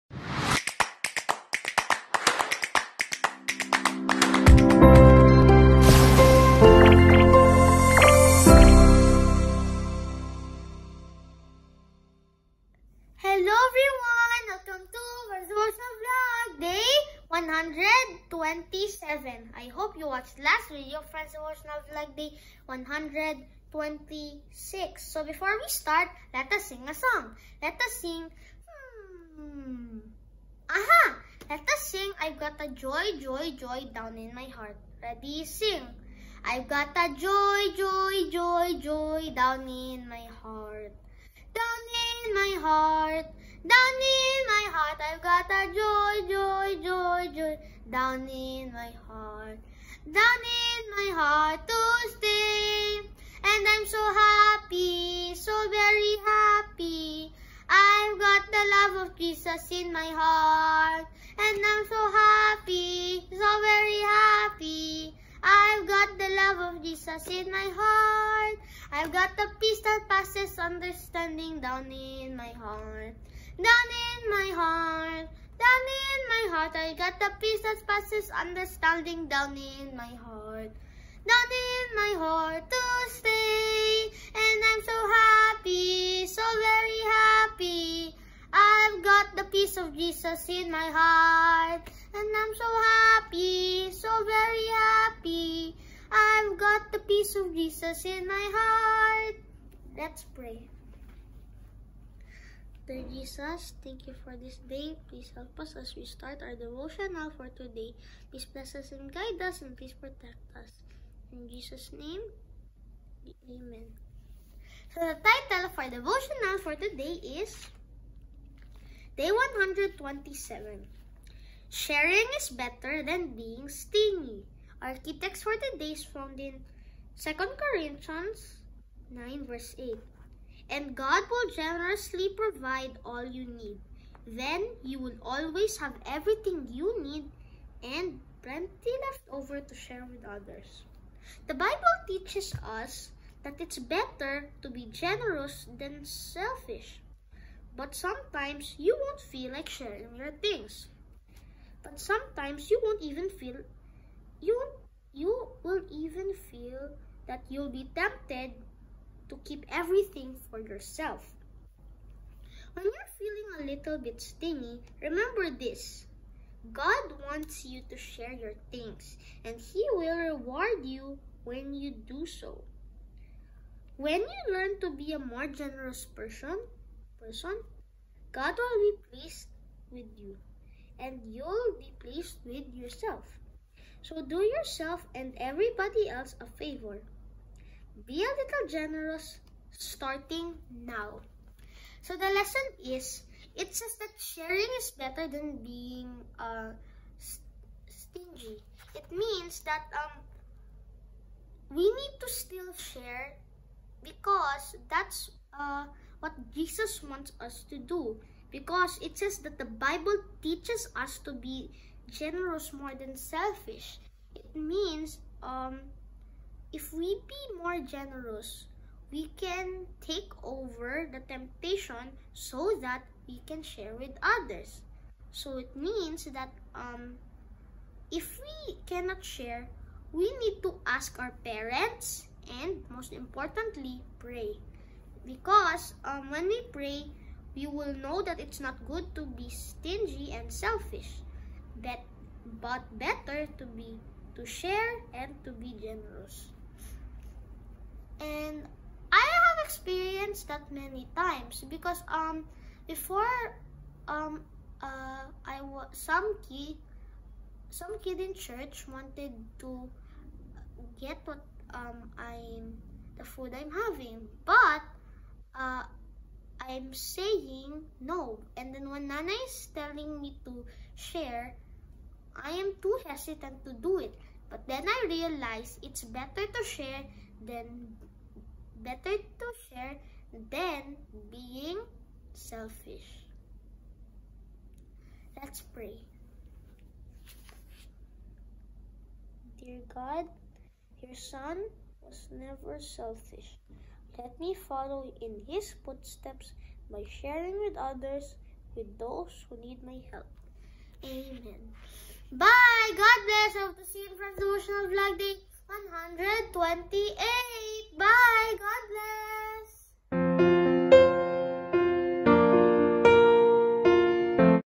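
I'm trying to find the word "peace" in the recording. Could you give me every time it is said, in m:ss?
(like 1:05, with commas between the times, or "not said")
1:09, 1:17, 1:29, 1:36.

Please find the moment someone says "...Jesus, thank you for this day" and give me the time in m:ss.
1:43.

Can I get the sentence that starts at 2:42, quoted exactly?
When you're feeling a little bit stingy, remember this.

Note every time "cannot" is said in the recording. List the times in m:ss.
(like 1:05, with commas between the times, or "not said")
3:48.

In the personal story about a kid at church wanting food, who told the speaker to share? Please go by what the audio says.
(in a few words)
Nana.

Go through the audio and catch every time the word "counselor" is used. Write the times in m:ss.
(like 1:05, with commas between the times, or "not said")
not said.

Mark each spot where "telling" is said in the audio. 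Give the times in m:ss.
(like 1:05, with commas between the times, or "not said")
4:29.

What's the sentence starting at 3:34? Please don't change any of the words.
It means um, if we be more generous, we can take over the temptation so that we can share with others.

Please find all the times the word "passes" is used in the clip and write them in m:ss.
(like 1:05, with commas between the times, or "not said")
1:10, 1:17.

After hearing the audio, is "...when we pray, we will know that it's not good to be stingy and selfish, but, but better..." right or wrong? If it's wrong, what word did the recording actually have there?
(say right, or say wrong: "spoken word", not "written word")
right.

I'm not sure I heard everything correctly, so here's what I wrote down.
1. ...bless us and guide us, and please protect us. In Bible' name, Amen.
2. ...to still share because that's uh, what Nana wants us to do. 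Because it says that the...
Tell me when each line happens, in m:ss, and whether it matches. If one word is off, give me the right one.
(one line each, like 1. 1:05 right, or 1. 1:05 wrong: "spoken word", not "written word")
1. 1:48 wrong: "Jesus", not "Bible"
2. 3:22 wrong: "Jesus", not "Nana".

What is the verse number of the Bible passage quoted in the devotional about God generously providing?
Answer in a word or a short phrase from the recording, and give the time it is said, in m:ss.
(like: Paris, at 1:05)
8, at 2:09.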